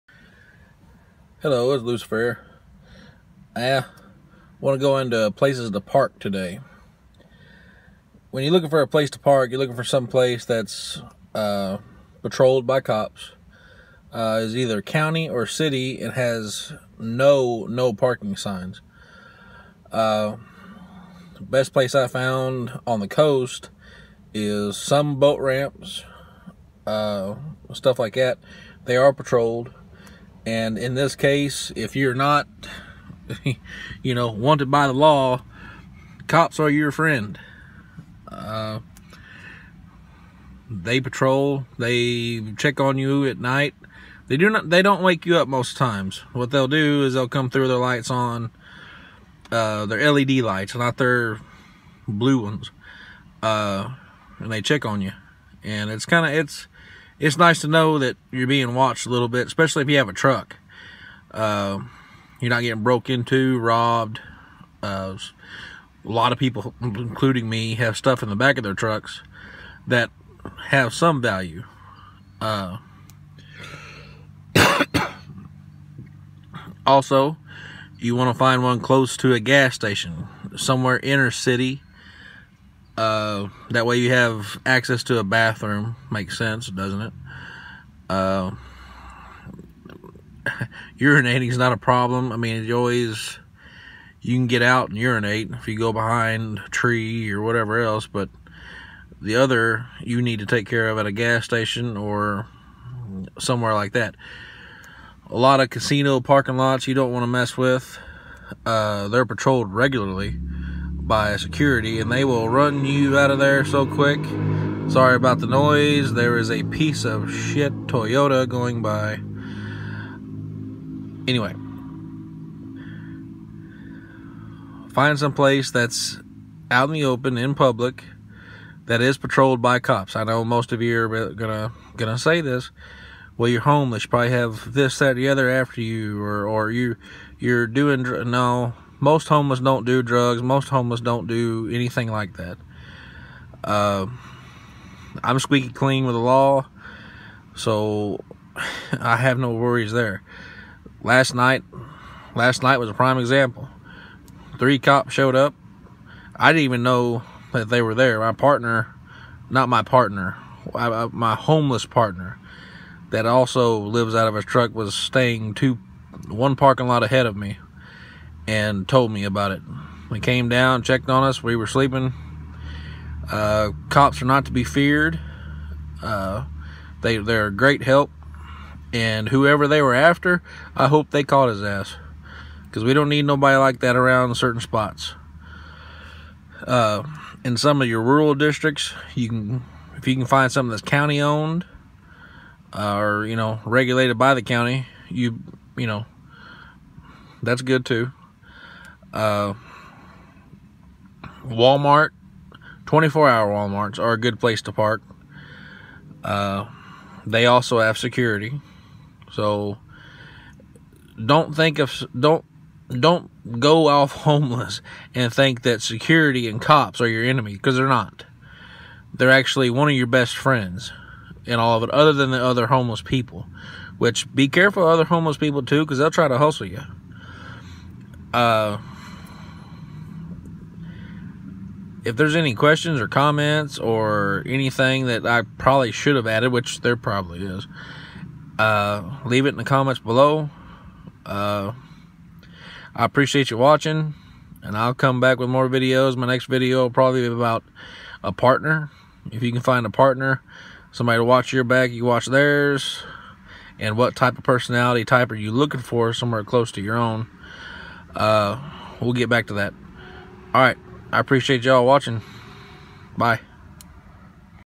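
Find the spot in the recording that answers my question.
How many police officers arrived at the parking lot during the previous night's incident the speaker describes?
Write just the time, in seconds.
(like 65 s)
154 s.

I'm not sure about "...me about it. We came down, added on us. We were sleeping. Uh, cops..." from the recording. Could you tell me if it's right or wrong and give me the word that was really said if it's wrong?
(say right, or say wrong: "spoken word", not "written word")
wrong: "checked", not "added".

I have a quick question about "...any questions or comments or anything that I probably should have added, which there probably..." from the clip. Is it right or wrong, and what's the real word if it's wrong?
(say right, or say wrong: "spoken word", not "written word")
right.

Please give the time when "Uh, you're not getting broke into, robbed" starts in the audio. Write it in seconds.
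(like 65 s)
61 s.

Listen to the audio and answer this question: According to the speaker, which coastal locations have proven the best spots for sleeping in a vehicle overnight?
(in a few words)
Boat ramps.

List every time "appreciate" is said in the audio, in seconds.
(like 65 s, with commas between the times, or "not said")
243 s, 261 s.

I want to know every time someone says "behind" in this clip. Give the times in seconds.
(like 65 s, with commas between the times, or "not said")
95 s.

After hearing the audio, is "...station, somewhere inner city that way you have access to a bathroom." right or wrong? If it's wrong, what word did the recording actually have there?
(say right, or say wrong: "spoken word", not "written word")
right.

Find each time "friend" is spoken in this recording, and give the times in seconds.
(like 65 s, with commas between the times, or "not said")
36 s, 220 s.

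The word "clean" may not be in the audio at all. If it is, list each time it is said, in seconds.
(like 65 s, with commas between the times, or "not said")
145 s.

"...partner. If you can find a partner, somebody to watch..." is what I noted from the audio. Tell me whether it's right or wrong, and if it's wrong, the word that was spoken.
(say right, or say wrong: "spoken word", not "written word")
right.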